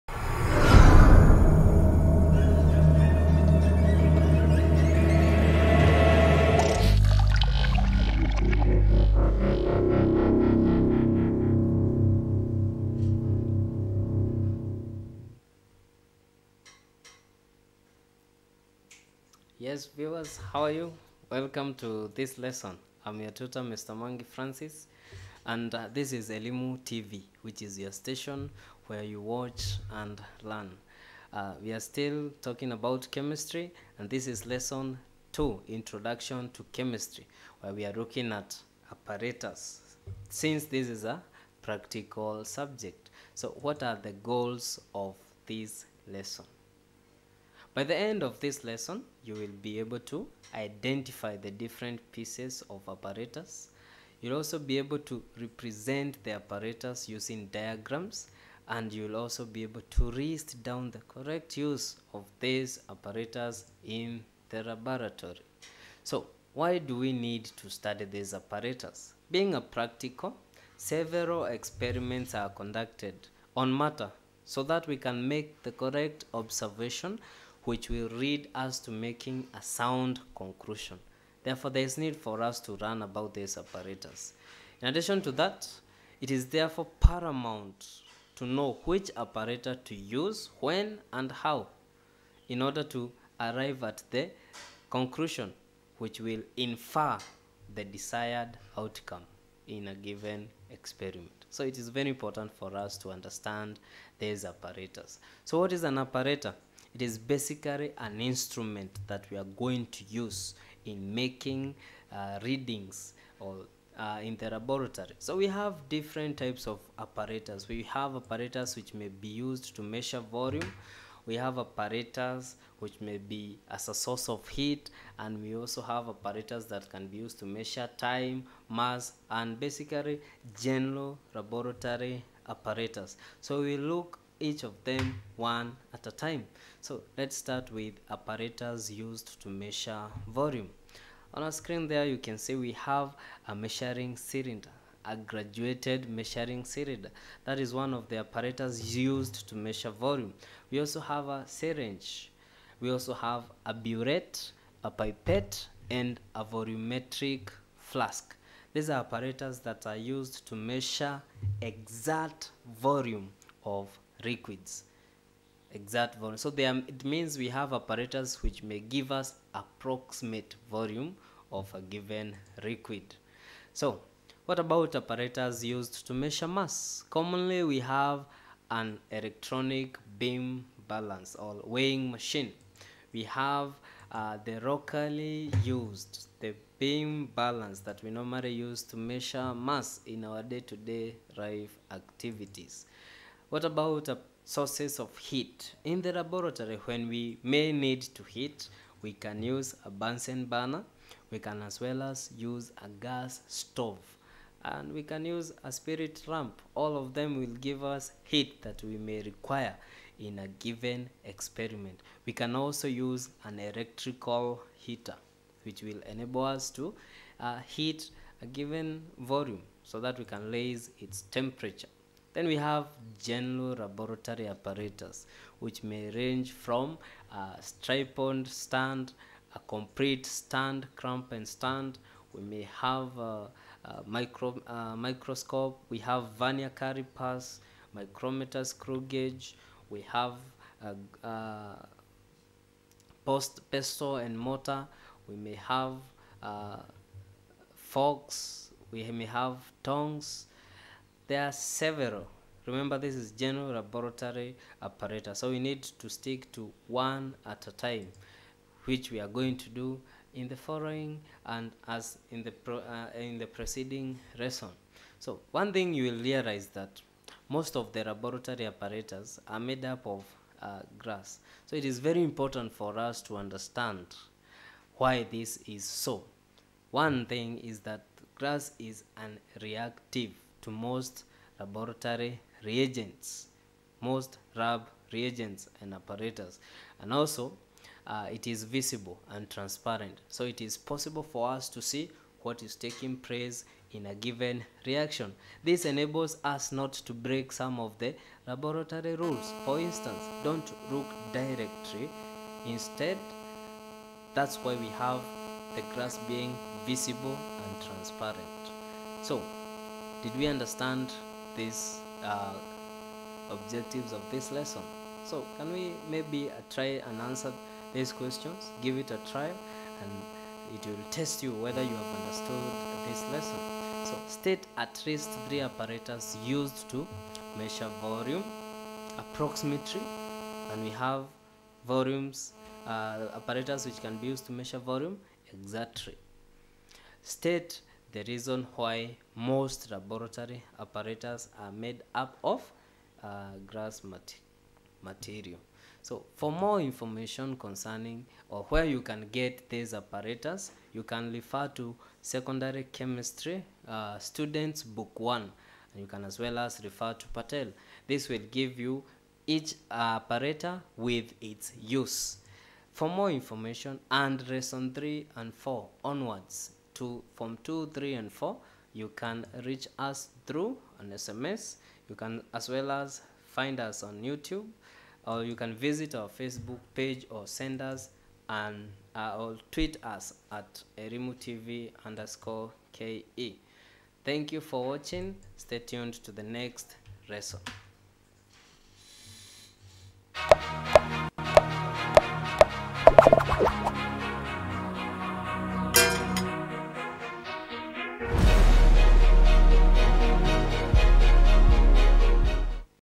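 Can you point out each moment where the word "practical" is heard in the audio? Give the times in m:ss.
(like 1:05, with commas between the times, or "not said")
0:41, 1:09.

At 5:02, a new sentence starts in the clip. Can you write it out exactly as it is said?
Instead, that's why we have the glass being visible and transparent.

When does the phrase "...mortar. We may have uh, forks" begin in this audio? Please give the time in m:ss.
4:04.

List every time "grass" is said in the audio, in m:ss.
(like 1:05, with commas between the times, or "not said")
4:30, 4:38, 5:43.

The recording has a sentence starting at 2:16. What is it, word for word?
So let's start with apparatus used to measure volume.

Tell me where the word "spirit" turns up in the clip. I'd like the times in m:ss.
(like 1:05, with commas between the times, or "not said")
3:25.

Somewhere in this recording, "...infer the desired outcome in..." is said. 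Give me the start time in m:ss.
1:36.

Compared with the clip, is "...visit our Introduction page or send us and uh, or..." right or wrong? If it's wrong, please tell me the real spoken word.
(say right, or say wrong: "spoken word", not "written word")
wrong: "Facebook", not "Introduction".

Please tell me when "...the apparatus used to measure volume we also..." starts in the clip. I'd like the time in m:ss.
2:28.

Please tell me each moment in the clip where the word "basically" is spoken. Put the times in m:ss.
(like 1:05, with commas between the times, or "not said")
1:47, 2:09.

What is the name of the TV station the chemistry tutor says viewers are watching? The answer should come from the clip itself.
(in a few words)
Elimu TV.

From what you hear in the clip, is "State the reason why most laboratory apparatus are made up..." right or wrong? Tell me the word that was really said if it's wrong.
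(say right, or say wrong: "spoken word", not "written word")
right.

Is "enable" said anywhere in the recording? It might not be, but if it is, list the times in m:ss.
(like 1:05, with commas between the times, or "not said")
3:36, 4:55.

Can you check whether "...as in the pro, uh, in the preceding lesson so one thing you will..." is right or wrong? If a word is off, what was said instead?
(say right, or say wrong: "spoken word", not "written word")
right.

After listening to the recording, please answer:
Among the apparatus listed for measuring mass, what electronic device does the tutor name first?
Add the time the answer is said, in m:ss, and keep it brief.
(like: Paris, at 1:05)
electronic beam balance, at 2:59.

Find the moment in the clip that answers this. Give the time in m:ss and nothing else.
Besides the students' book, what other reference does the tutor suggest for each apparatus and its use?
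5:57.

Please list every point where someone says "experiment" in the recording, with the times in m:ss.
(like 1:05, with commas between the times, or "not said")
1:11, 1:40, 3:31.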